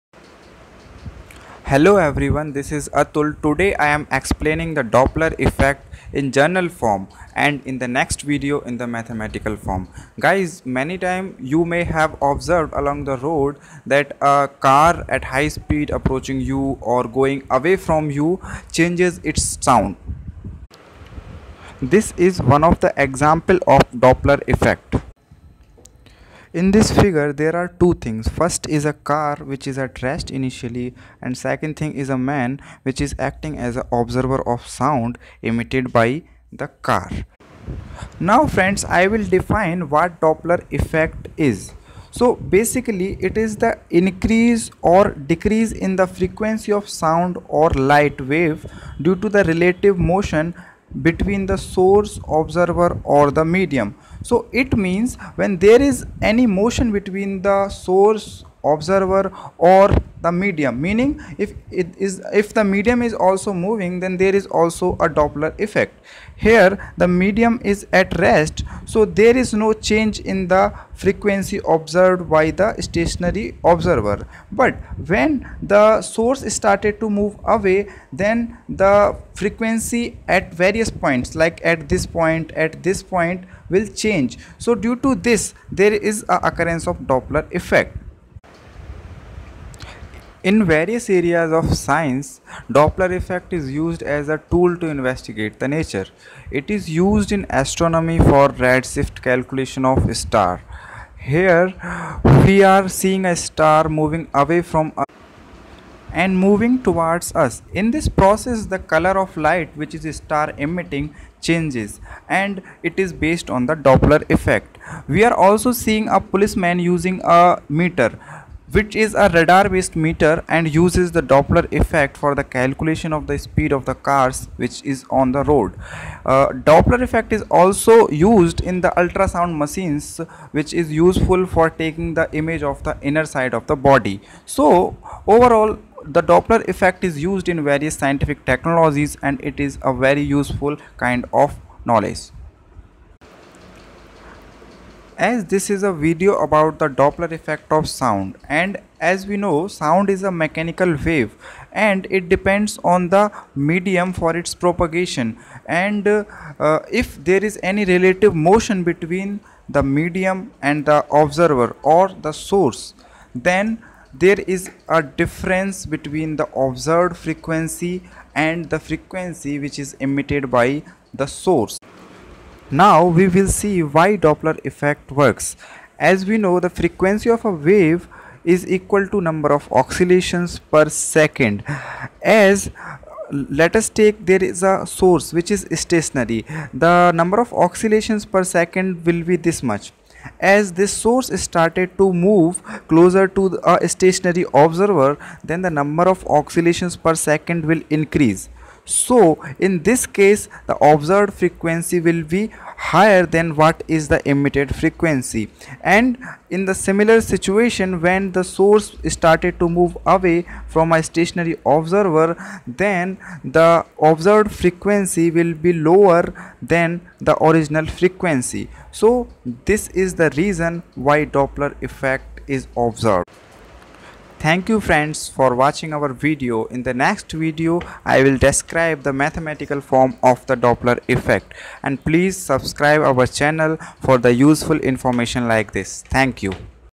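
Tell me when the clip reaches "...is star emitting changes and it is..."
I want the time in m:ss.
1:49.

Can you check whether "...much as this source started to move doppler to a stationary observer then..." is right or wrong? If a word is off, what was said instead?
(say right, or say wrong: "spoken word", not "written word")
wrong: "closer", not "doppler".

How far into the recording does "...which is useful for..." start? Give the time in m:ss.
2:10.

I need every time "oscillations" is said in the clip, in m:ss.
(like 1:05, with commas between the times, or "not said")
2:59, 3:07, 3:16.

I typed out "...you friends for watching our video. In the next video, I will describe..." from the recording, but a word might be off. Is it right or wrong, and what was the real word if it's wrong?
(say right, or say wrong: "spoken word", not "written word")
right.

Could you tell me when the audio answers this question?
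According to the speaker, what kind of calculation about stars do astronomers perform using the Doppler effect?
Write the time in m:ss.
1:38.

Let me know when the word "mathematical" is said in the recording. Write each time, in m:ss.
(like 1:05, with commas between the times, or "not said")
0:08, 3:49.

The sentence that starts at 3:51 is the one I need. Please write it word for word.
And please subscribe our channel for the useful information like this.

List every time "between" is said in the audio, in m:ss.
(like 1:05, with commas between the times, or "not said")
0:51, 0:56, 2:38, 2:45.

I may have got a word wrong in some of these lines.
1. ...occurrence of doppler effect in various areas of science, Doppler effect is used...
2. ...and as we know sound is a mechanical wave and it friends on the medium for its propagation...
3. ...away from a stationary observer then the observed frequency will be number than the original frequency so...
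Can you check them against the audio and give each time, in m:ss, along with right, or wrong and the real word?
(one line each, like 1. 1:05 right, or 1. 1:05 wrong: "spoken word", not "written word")
1. 1:26 right
2. 2:28 wrong: "depends", not "friends"
3. 3:30 wrong: "lower", not "number".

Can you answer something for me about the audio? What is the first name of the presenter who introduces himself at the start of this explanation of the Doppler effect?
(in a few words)
Atul.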